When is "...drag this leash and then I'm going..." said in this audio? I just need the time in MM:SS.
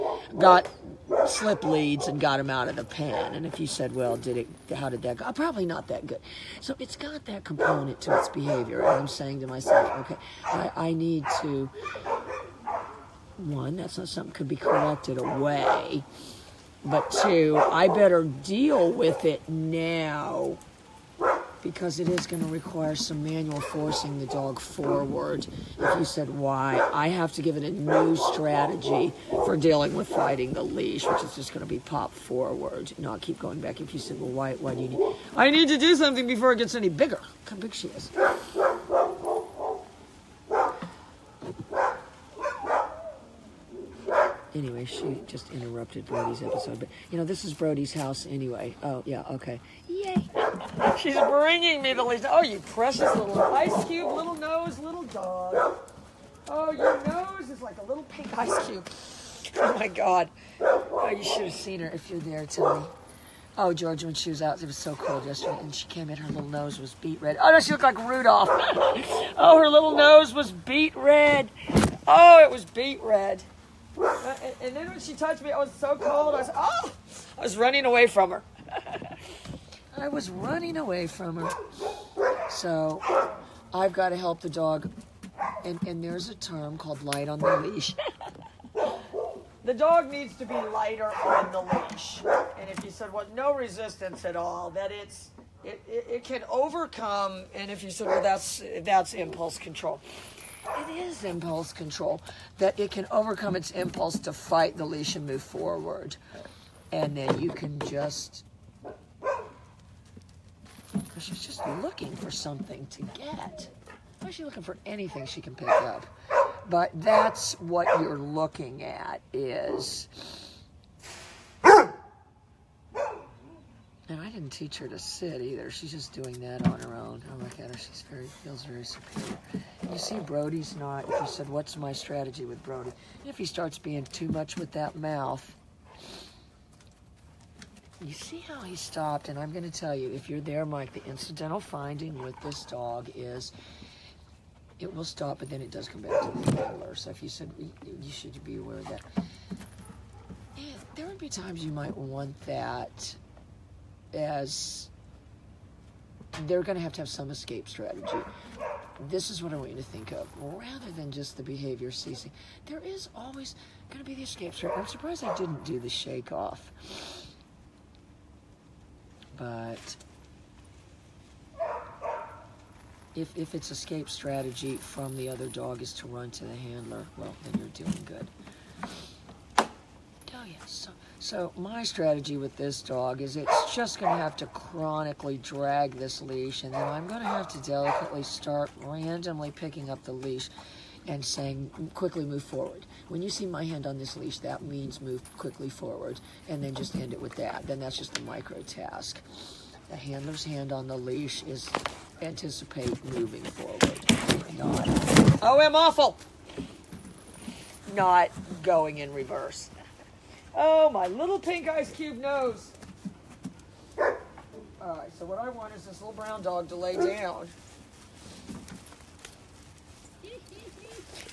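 03:05.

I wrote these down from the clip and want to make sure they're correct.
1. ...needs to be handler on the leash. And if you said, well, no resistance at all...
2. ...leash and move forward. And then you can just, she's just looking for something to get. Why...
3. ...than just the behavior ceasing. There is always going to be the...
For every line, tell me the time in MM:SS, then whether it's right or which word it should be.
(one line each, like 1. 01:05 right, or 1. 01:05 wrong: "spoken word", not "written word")
1. 01:30 wrong: "lighter", not "handler"
2. 01:44 right
3. 02:40 right.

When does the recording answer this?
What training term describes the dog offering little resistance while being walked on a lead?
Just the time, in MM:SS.
01:27.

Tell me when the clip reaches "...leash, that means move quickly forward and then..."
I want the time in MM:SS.
03:14.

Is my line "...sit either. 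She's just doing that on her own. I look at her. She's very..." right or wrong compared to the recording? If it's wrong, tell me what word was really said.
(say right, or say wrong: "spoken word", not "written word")
right.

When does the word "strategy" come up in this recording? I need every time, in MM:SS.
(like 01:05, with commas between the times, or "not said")
00:28, 02:11, 02:37, 02:44, 02:54, 03:01.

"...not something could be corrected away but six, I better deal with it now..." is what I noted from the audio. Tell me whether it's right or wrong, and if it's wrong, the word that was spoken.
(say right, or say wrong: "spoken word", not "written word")
wrong: "two", not "six".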